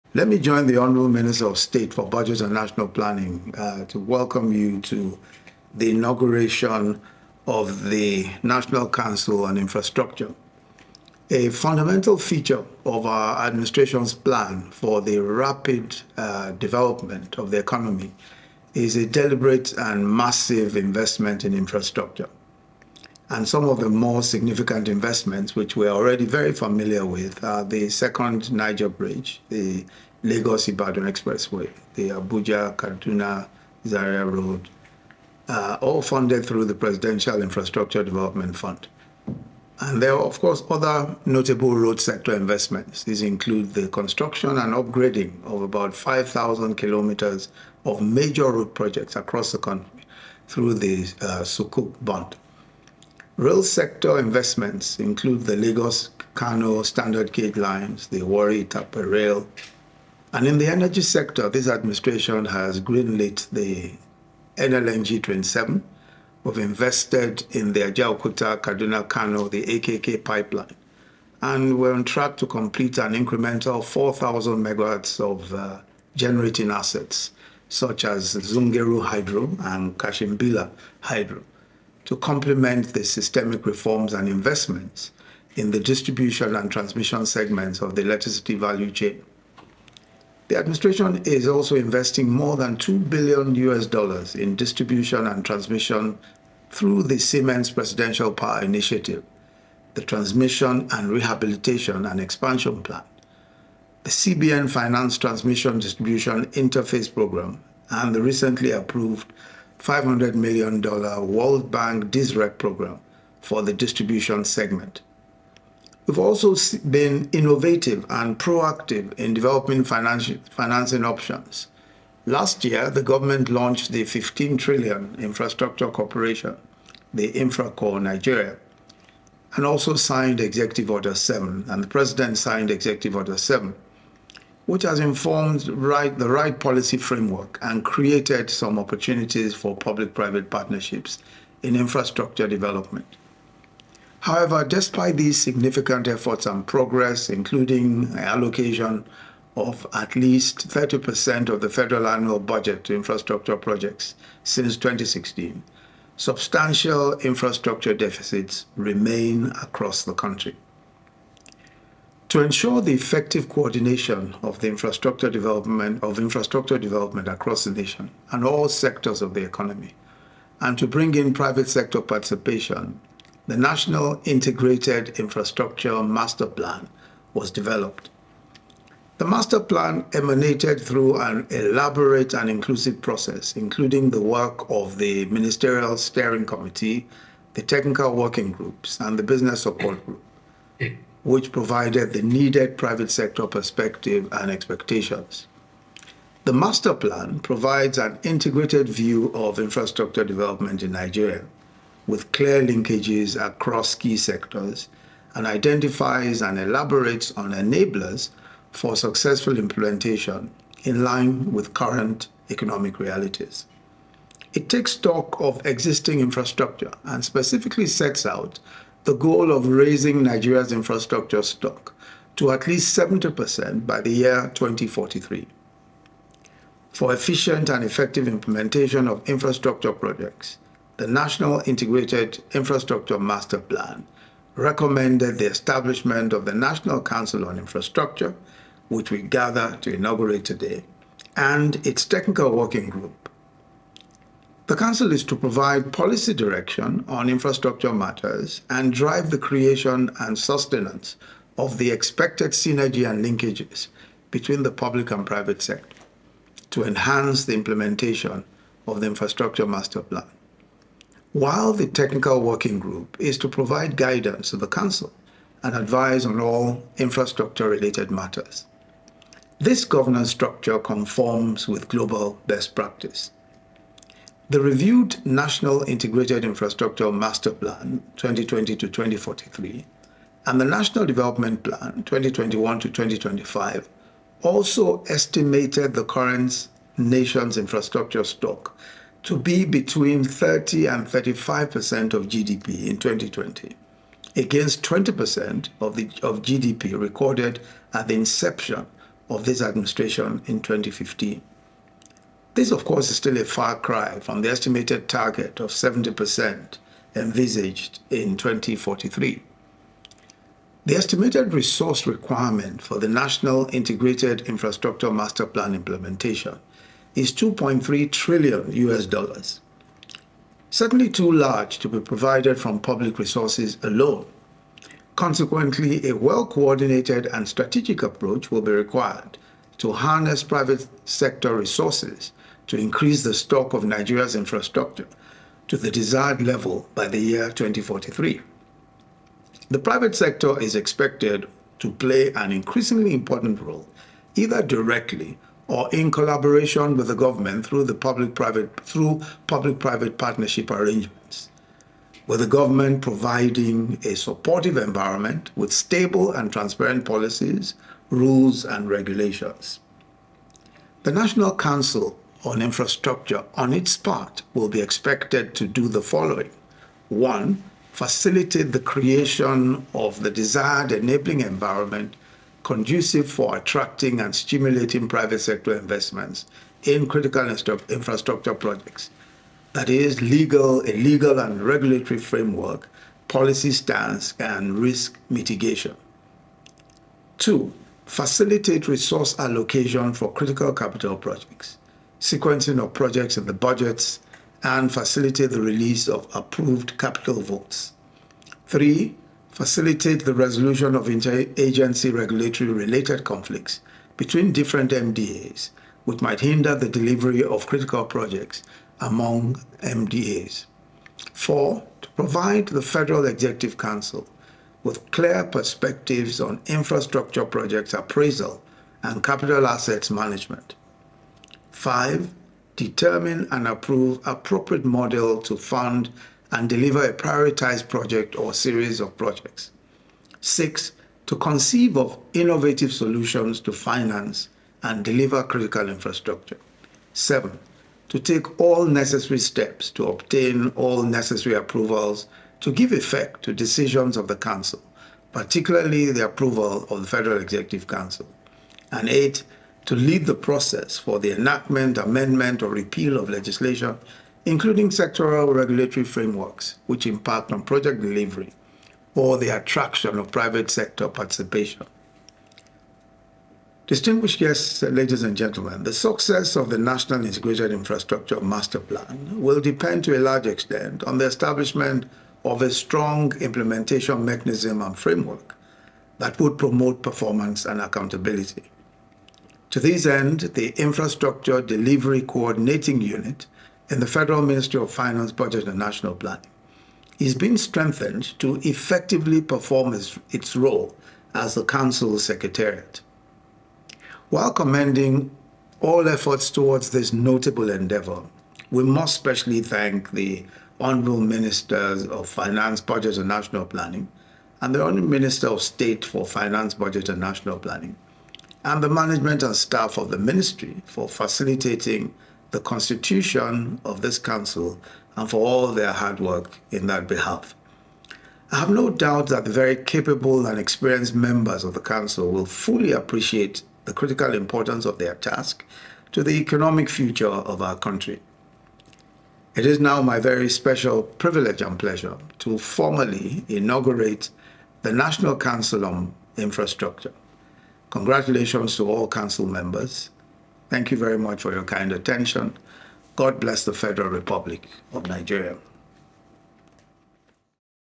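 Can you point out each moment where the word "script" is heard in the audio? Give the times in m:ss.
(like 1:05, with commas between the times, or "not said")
not said.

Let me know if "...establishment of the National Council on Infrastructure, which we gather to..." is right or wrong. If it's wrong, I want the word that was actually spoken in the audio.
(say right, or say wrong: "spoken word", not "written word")
right.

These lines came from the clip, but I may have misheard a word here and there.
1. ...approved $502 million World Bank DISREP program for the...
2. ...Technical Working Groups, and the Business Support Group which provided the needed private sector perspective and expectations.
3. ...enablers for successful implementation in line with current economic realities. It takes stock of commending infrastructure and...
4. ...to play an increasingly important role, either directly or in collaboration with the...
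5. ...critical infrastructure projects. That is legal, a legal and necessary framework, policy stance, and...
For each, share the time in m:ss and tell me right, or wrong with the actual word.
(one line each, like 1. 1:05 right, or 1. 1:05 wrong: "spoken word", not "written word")
1. 1:48 wrong: "500", not "502"
2. 3:07 right
3. 3:27 wrong: "existing", not "commending"
4. 5:41 right
5. 6:17 wrong: "regulatory", not "necessary".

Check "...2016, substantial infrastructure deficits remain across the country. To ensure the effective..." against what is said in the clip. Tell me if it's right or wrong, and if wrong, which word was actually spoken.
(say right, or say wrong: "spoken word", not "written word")
right.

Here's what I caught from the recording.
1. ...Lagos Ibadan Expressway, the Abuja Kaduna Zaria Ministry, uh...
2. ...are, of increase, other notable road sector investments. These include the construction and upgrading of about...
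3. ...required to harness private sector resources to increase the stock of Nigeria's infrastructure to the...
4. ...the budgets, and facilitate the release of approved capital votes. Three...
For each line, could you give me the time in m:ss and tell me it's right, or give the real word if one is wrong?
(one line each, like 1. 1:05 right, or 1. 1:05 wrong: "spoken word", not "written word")
1. 0:30 wrong: "Road", not "Ministry"
2. 0:40 wrong: "course", not "increase"
3. 5:28 right
4. 6:33 right.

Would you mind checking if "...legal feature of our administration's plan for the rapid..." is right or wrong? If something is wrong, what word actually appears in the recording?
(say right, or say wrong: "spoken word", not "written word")
wrong: "fundamental", not "legal".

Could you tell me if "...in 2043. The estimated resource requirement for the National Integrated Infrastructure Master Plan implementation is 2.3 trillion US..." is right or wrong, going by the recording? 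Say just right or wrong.
right.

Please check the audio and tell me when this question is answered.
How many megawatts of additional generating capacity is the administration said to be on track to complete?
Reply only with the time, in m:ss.
1:13.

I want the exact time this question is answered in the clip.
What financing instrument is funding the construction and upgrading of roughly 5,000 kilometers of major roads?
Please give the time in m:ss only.
0:51.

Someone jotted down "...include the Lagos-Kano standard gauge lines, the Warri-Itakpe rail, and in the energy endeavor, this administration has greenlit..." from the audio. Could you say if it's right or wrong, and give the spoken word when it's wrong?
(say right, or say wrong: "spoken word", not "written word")
wrong: "sector", not "endeavor".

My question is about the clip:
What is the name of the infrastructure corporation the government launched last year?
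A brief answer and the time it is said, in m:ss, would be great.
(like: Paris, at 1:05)
InfraCorp Nigeria, at 2:07.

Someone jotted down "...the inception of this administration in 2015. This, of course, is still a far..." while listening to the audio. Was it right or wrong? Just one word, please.
right.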